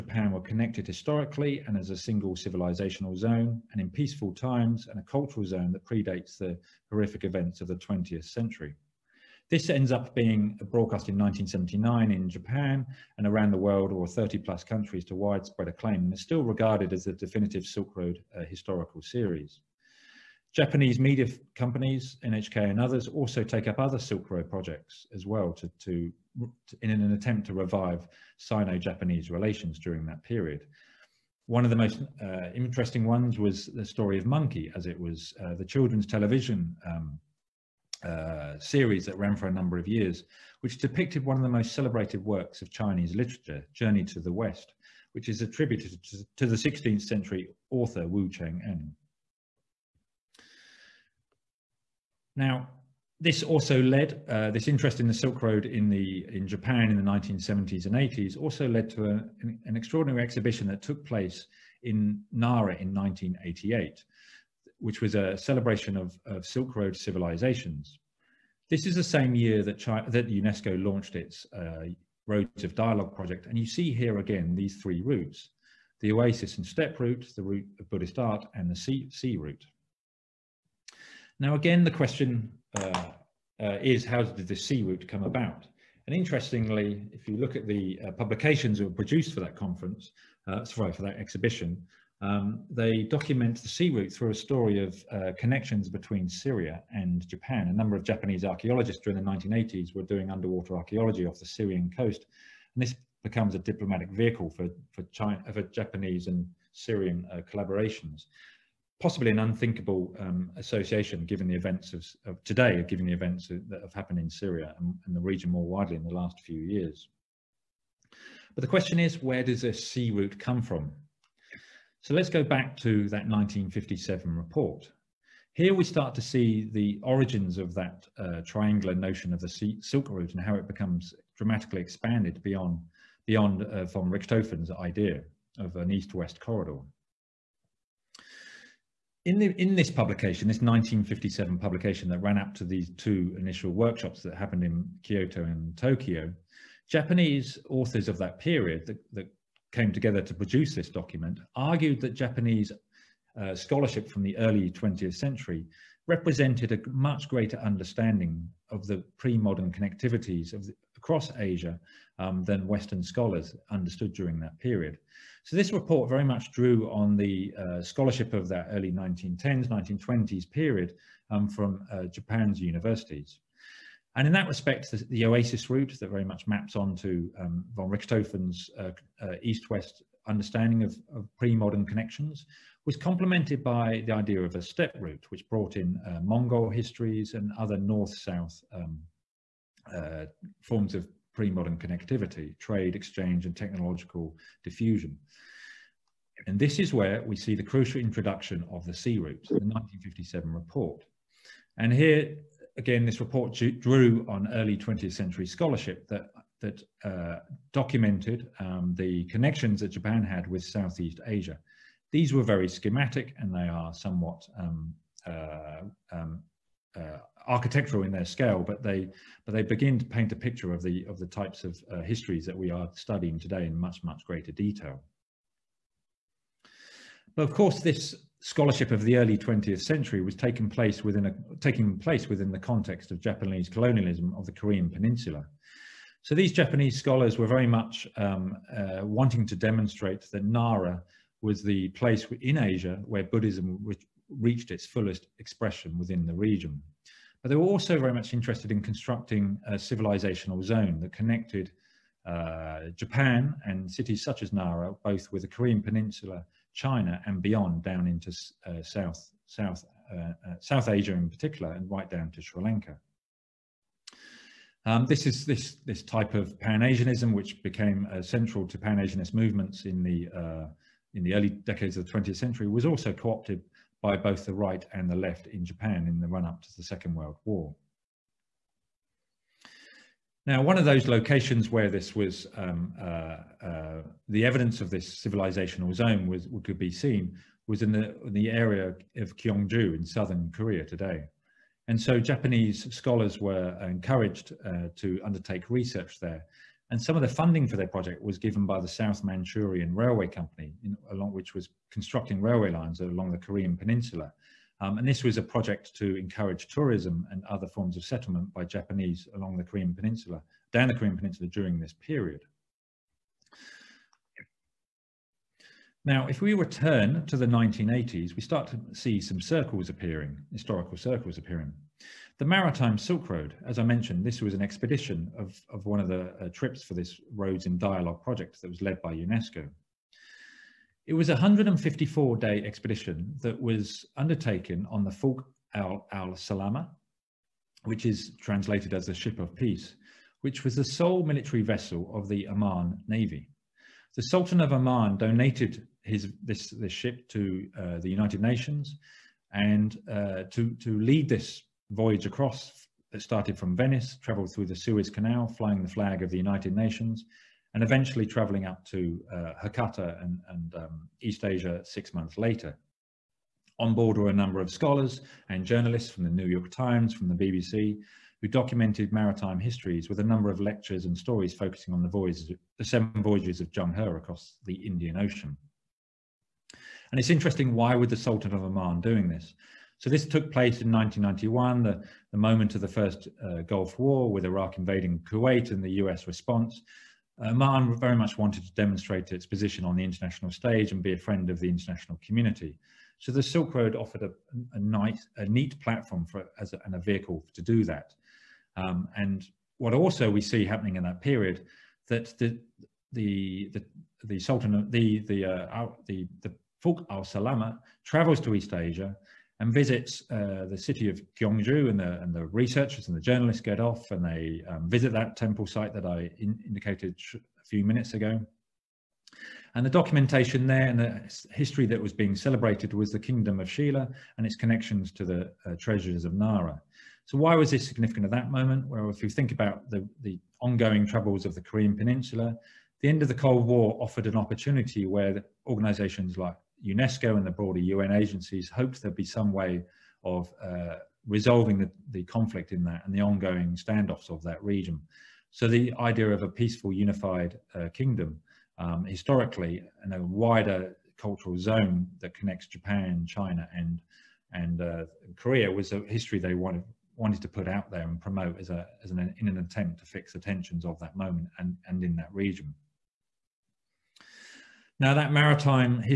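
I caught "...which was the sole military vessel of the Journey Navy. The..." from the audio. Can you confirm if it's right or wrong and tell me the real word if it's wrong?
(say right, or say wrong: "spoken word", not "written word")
wrong: "Oman", not "Journey".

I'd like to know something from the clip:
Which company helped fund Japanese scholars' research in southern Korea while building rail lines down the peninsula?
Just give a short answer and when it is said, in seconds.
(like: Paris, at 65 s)
South Manchurian Railway Company, at 298 s.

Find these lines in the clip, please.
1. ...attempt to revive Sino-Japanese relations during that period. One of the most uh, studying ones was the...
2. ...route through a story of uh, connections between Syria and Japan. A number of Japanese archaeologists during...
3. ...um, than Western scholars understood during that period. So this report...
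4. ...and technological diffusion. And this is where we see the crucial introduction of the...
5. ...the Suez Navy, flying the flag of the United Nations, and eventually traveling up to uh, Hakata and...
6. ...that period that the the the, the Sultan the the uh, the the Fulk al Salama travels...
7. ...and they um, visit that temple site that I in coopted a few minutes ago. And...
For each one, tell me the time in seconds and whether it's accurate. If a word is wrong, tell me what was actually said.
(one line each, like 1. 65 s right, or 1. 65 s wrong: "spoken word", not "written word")
1. 27 s wrong: "interesting", not "studying"
2. 93 s right
3. 162 s right
4. 193 s right
5. 354 s wrong: "Canal", not "Navy"
6. 401 s right
7. 414 s wrong: "indicated", not "coopted".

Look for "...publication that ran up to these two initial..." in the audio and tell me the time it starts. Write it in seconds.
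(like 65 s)
141 s.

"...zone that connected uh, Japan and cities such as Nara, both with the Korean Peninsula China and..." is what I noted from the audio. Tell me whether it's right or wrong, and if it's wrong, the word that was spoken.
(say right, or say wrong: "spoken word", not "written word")
right.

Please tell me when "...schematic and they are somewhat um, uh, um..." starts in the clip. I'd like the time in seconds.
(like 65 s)
212 s.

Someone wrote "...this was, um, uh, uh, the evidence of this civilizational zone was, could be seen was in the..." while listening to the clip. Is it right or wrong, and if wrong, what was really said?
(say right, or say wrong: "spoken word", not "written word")
right.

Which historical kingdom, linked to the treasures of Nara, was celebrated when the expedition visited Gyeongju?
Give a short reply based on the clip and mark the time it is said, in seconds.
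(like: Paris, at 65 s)
Shila, at 423 s.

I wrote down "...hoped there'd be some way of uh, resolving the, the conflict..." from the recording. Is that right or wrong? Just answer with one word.
right.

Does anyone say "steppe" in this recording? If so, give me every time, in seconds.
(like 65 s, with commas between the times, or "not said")
76 s, 184 s.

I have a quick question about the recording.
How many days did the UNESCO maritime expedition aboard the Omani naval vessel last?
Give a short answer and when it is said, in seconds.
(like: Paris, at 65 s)
154, at 331 s.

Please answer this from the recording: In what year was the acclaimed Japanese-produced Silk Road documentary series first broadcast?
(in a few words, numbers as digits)
1979.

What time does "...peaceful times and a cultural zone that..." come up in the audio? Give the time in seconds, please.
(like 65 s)
3 s.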